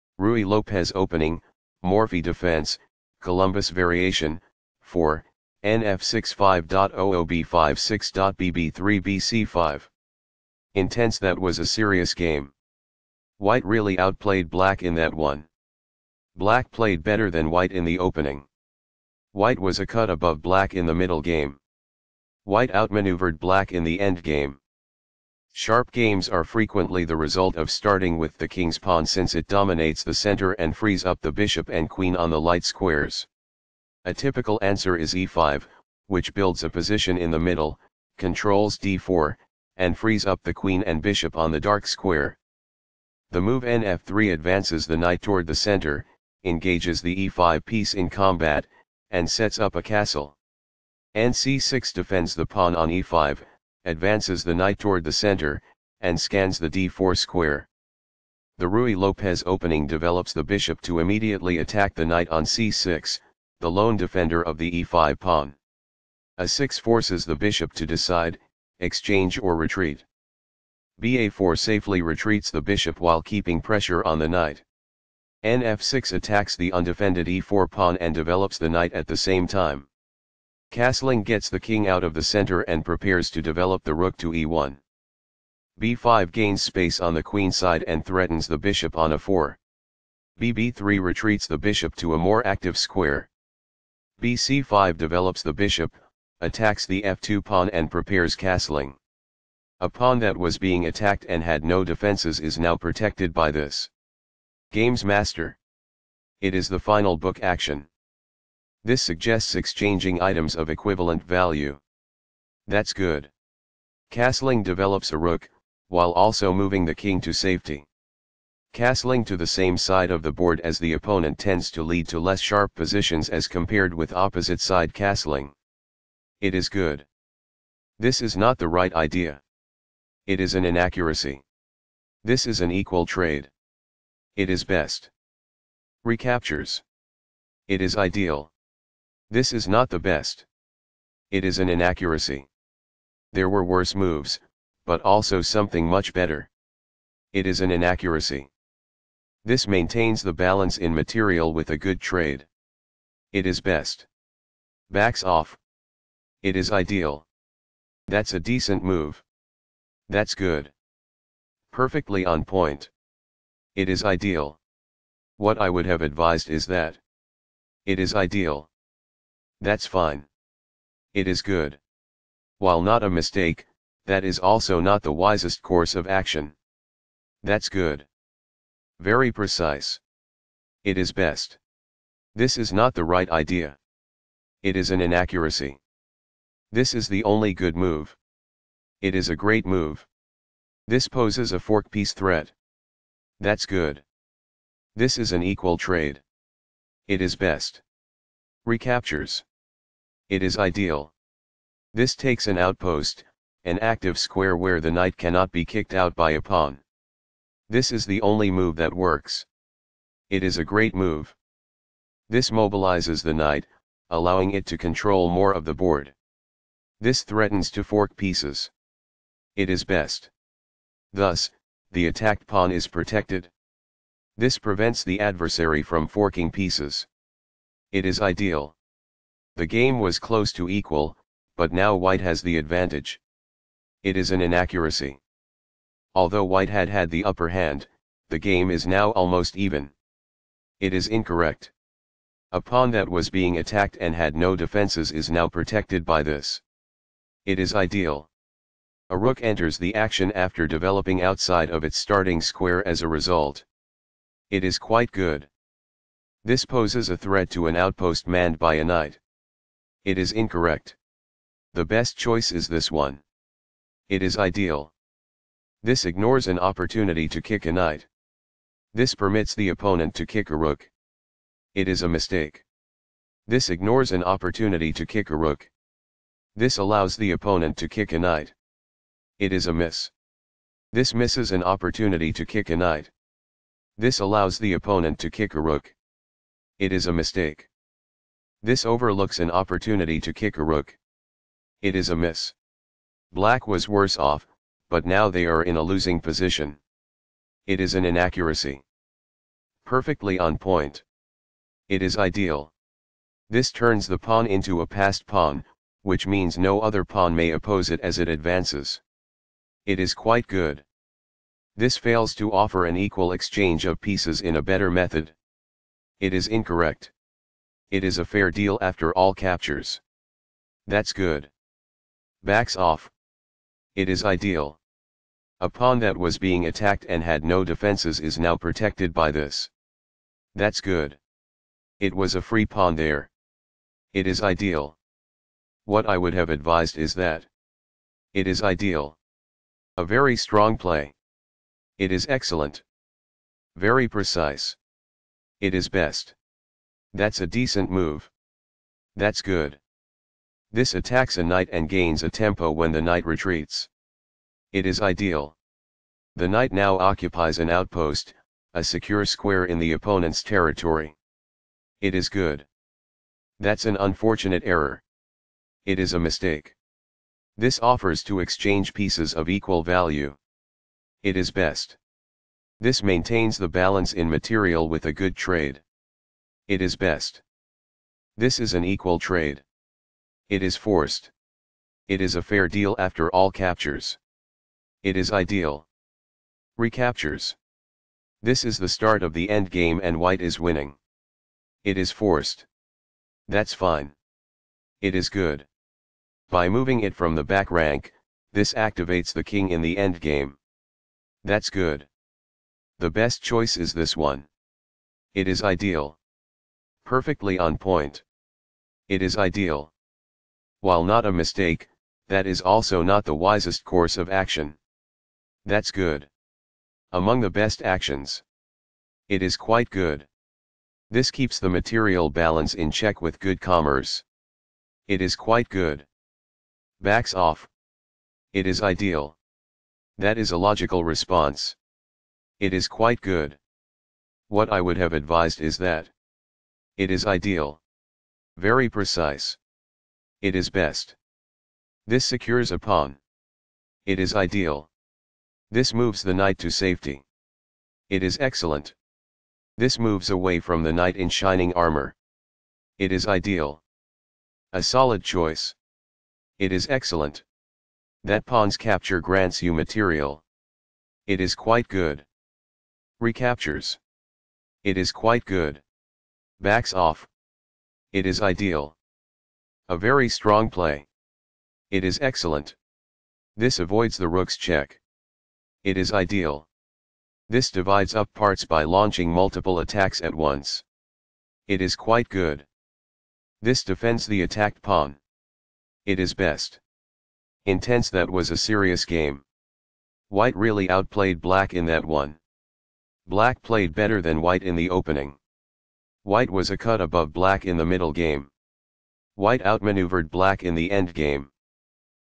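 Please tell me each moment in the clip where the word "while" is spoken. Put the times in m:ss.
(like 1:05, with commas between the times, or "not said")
1:12, 1:55, 2:52, 6:50.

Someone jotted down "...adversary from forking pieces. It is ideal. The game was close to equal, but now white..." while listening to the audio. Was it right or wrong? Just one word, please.
right.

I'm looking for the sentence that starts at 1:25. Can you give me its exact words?
b5 gains space on the queen side and threatens the bishop on a4.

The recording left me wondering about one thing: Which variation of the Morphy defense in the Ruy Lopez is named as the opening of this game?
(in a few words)
Columbus variation.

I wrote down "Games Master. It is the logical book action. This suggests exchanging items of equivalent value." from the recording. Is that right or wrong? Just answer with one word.
wrong.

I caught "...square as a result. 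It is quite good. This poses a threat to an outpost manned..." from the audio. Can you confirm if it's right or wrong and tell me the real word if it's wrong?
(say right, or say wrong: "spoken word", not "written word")
right.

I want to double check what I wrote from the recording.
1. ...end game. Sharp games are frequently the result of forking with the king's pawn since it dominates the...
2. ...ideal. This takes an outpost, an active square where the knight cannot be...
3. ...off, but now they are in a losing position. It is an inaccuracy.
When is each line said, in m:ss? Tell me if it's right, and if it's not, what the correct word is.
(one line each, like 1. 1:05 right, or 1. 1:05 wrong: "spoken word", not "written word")
1. 0:23 wrong: "starting", not "forking"
2. 3:20 right
3. 4:54 right.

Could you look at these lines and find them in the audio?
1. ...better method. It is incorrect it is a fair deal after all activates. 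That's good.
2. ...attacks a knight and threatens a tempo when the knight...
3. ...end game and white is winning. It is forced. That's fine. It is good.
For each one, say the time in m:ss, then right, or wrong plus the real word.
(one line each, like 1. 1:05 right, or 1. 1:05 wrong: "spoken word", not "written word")
1. 5:14 wrong: "captures", not "activates"
2. 5:50 wrong: "gains", not "threatens"
3. 6:29 right.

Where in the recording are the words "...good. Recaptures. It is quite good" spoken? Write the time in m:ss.
7:41.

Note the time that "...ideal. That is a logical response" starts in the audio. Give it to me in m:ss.
7:08.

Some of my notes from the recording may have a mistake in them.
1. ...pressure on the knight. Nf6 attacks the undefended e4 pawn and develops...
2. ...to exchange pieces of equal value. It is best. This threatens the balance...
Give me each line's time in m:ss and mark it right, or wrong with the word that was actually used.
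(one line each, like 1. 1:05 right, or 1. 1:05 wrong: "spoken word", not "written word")
1. 1:13 right
2. 6:08 wrong: "maintains", not "threatens".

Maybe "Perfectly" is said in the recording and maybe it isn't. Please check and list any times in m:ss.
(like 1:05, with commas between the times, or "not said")
2:41, 4:59, 6:47.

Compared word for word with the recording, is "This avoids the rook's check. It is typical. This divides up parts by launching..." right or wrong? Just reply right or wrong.
wrong.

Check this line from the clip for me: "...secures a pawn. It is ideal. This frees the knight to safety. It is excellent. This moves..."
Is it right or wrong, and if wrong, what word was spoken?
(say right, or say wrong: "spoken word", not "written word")
wrong: "moves", not "frees".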